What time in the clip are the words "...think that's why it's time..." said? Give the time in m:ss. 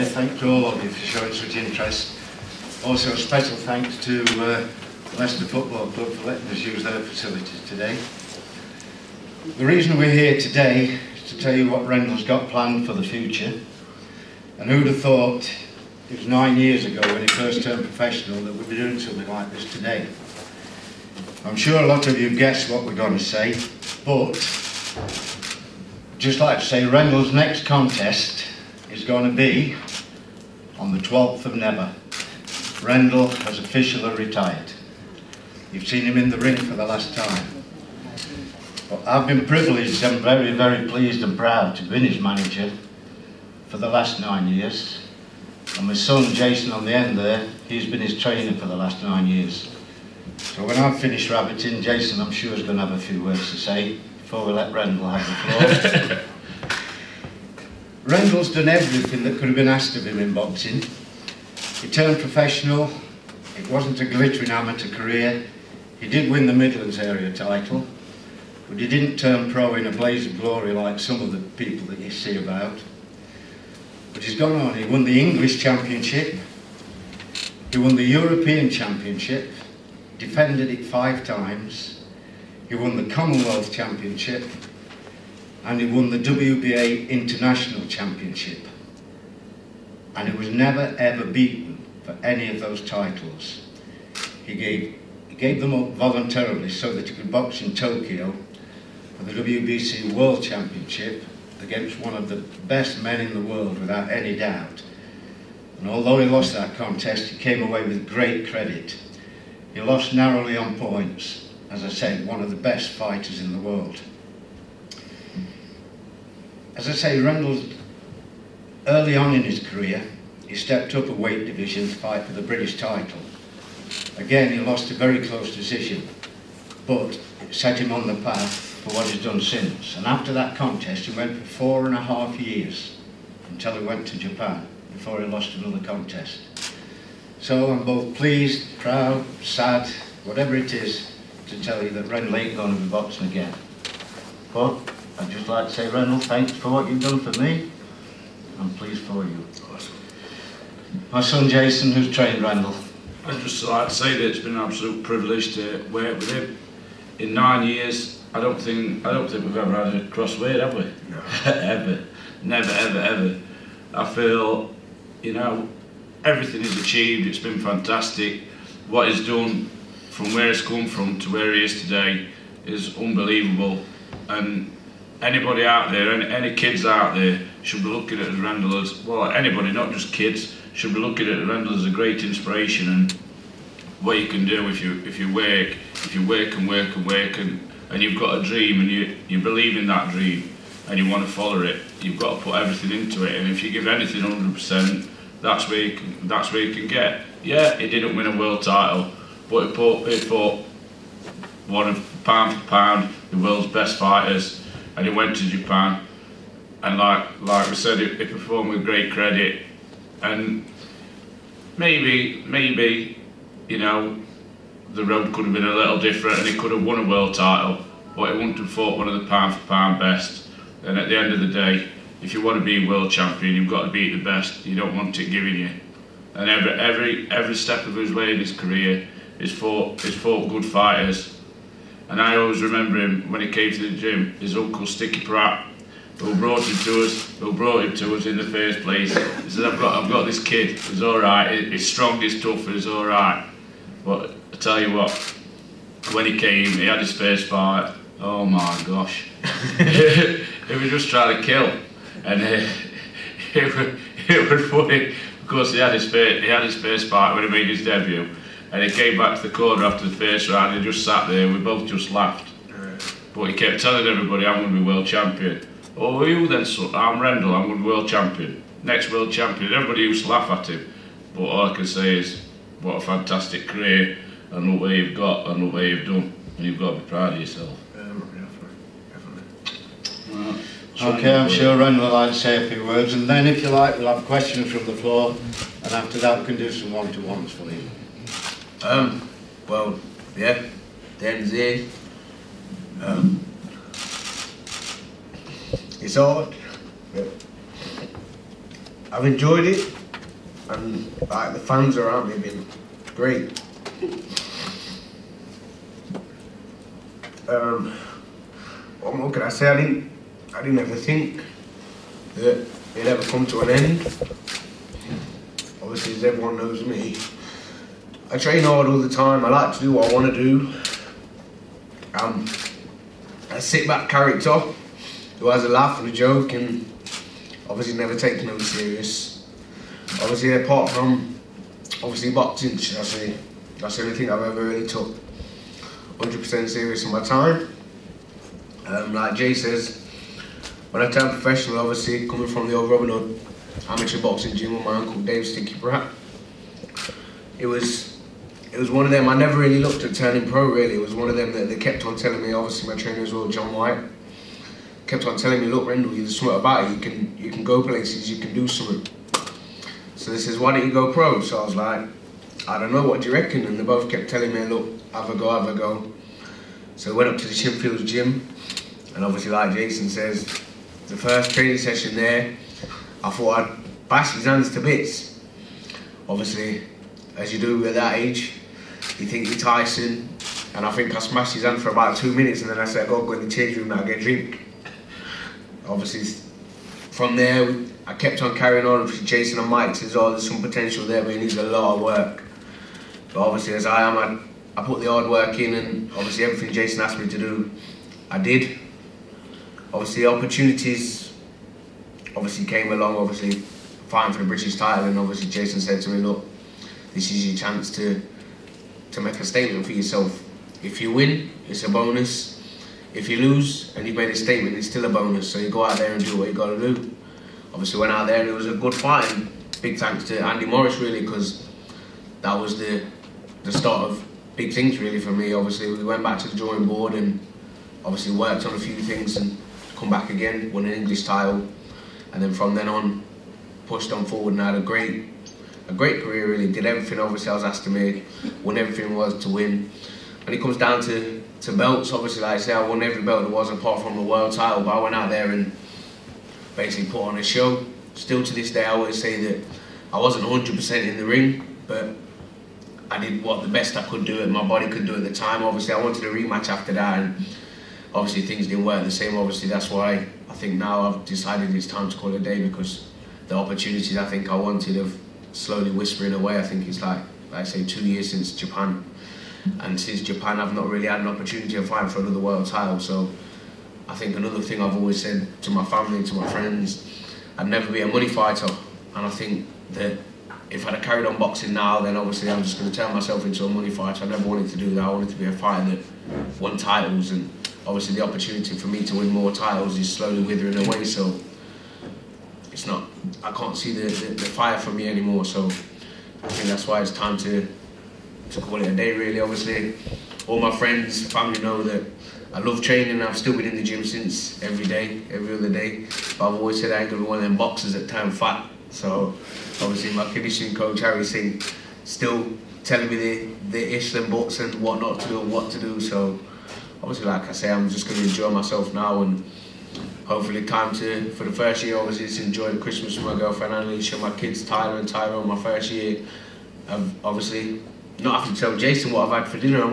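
8:16.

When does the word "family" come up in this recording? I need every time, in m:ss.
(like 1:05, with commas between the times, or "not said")
7:55, 8:21.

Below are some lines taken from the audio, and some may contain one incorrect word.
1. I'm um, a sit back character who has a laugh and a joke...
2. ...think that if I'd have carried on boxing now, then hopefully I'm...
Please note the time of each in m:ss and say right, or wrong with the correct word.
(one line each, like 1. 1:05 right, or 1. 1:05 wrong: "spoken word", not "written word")
1. 5:22 right
2. 7:59 wrong: "obviously", not "hopefully".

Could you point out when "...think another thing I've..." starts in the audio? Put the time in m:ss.
7:54.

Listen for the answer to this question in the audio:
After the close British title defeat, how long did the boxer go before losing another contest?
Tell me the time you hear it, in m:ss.
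2:11.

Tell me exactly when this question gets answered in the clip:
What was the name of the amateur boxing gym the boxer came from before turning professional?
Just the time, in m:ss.
5:42.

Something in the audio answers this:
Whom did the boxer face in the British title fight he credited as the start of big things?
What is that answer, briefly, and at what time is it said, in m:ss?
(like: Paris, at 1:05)
Andy Morris, at 7:00.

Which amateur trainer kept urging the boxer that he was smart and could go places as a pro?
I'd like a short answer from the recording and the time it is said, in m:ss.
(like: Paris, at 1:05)
John White, at 5:53.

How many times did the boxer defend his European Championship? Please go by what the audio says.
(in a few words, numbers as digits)
5.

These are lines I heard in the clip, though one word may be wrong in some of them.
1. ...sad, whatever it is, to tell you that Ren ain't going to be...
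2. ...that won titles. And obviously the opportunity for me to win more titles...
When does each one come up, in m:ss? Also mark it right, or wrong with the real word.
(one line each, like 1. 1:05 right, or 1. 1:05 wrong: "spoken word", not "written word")
1. 2:19 right
2. 8:05 right.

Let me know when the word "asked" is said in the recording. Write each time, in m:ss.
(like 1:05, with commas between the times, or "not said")
0:59, 6:37, 7:17.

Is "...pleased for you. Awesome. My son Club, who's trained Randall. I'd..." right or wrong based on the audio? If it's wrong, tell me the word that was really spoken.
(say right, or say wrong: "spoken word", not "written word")
wrong: "Jason", not "Club".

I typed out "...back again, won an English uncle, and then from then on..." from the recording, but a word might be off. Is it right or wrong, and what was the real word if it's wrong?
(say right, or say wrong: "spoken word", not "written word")
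wrong: "title", not "uncle".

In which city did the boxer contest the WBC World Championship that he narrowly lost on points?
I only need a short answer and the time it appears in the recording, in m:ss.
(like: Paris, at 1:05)
Tokyo, at 1:37.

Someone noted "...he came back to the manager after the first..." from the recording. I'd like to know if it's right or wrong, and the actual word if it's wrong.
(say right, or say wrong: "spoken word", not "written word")
wrong: "corner", not "manager".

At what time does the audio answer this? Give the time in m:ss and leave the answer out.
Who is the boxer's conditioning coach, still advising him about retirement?
8:31.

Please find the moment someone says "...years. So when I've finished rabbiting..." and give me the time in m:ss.
0:49.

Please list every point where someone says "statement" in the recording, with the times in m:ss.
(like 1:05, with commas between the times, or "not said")
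6:49, 6:54.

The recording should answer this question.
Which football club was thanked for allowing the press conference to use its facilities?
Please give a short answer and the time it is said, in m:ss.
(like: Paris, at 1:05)
Leicester Football Club, at 0:05.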